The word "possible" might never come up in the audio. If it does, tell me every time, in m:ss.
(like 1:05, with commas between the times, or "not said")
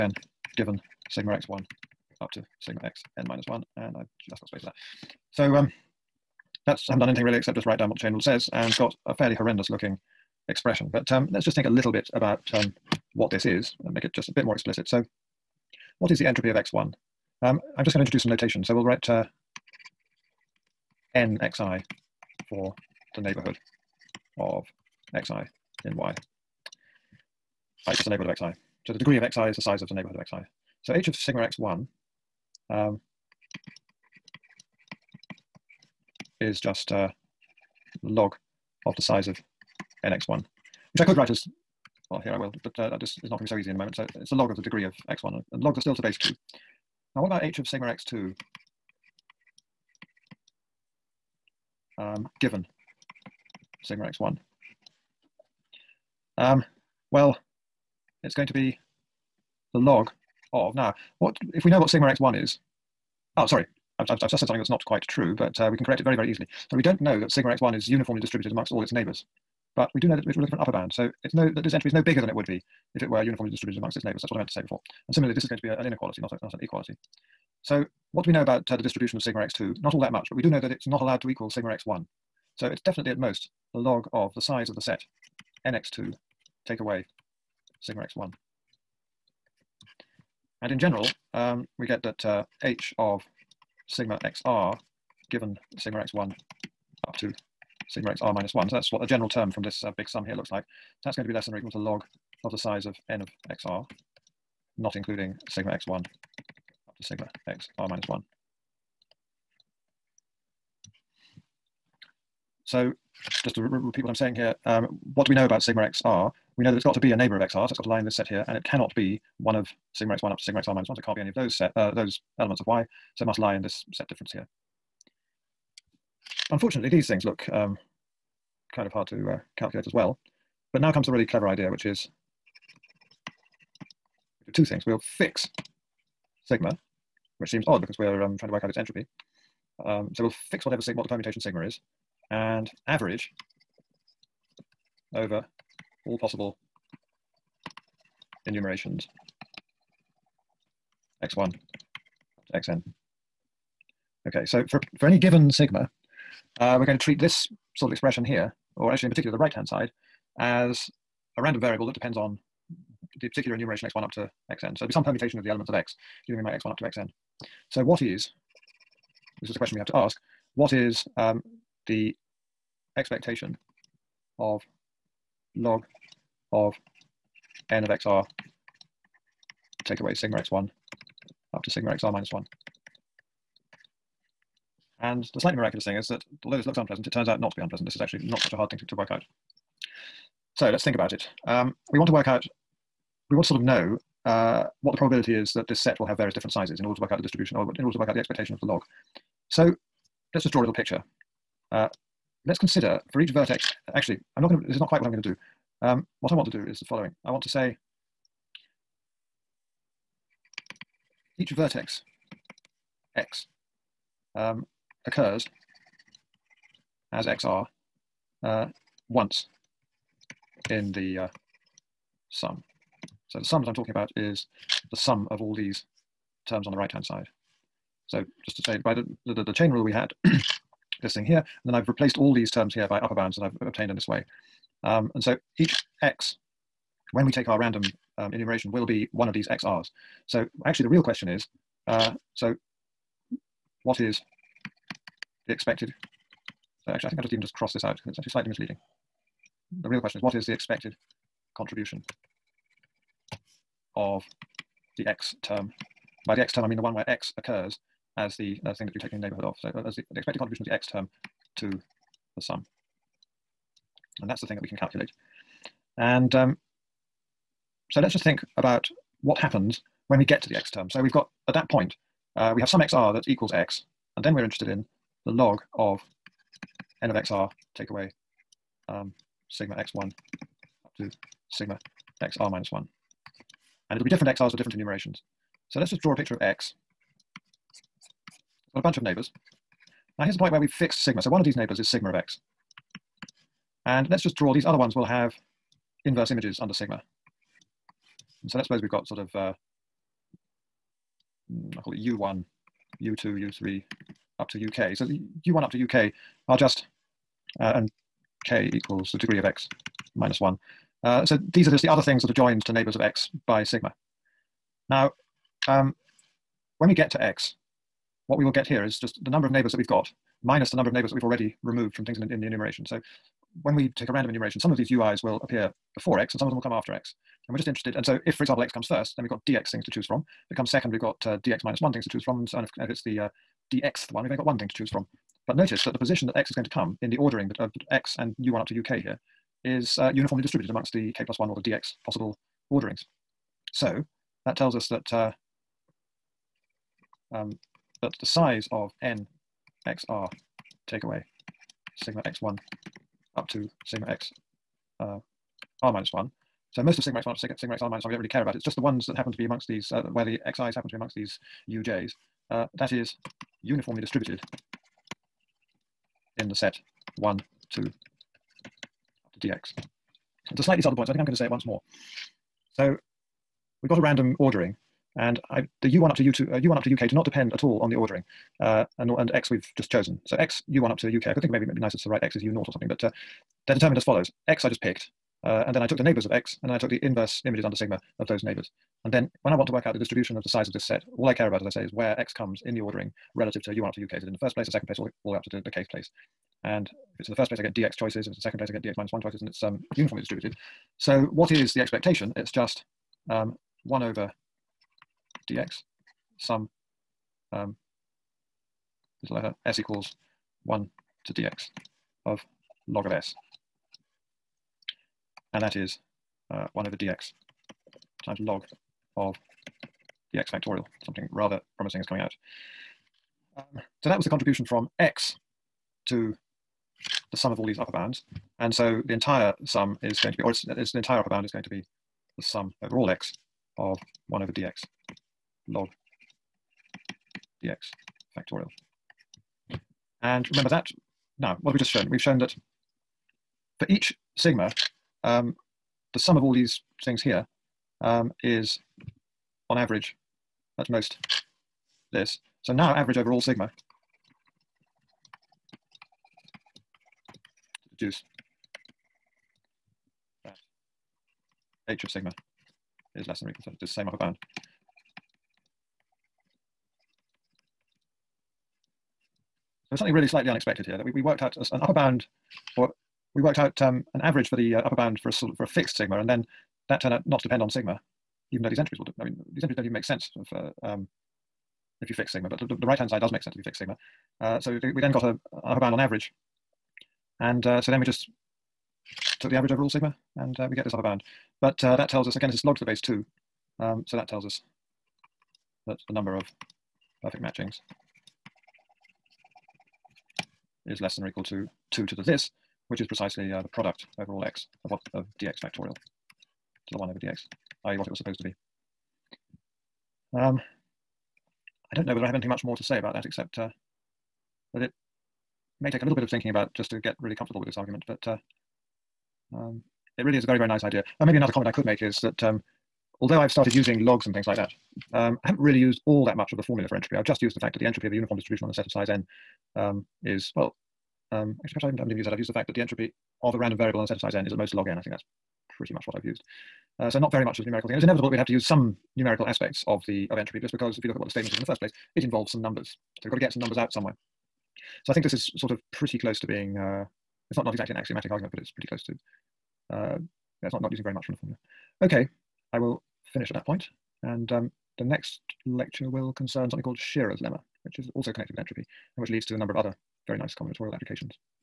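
2:26, 5:42.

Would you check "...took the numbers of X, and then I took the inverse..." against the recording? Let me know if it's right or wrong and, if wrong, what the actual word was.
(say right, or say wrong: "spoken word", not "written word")
wrong: "neighbors", not "numbers".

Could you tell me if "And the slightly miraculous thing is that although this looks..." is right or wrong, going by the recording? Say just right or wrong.
right.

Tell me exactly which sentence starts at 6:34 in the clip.
Is it in the first place, the second place, all the, all the way up to the, the kth place?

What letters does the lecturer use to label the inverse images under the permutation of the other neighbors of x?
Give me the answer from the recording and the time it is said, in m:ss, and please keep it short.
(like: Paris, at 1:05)
U1 up to UK, at 5:01.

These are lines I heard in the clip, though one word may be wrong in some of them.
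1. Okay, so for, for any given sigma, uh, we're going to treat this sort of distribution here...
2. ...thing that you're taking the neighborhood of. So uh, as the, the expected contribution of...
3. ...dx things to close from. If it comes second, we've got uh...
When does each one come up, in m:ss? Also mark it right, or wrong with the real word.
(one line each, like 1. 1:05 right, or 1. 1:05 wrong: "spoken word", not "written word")
1. 2:34 wrong: "expression", not "distribution"
2. 4:18 right
3. 5:29 wrong: "choose", not "close".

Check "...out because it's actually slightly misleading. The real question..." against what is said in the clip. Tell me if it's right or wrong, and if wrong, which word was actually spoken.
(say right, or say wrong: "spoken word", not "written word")
right.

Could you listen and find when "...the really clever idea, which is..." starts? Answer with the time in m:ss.
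2:11.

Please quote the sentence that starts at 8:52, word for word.
I've used the fact that the entropy of a random variable on a set of size n is at most log n.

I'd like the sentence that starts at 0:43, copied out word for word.
So it's the log of the degree of x1, and logs are still to base 2.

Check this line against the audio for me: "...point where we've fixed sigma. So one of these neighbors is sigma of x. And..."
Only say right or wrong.
right.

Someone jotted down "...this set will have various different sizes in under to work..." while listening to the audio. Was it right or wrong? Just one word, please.
wrong.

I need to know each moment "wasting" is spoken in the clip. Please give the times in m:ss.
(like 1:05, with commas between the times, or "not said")
not said.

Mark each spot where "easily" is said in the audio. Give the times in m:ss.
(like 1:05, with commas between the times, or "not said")
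1:06.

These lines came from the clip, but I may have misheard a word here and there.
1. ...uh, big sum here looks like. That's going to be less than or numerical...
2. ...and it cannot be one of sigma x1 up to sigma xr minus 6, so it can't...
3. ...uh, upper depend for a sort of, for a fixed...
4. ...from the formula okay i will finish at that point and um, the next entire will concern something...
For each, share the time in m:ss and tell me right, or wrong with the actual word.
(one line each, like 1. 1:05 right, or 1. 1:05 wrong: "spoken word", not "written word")
1. 1:39 wrong: "equal", not "numerical"
2. 1:58 wrong: "1", not "6"
3. 7:54 wrong: "bound", not "depend"
4. 9:11 wrong: "lecture", not "entire".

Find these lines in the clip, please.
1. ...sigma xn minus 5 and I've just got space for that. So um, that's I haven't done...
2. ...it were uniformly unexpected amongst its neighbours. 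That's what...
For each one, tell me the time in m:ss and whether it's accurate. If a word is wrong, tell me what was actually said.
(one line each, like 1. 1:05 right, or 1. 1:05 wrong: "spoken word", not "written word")
1. 0:02 wrong: "1", not "5"
2. 1:13 wrong: "distributed", not "unexpected".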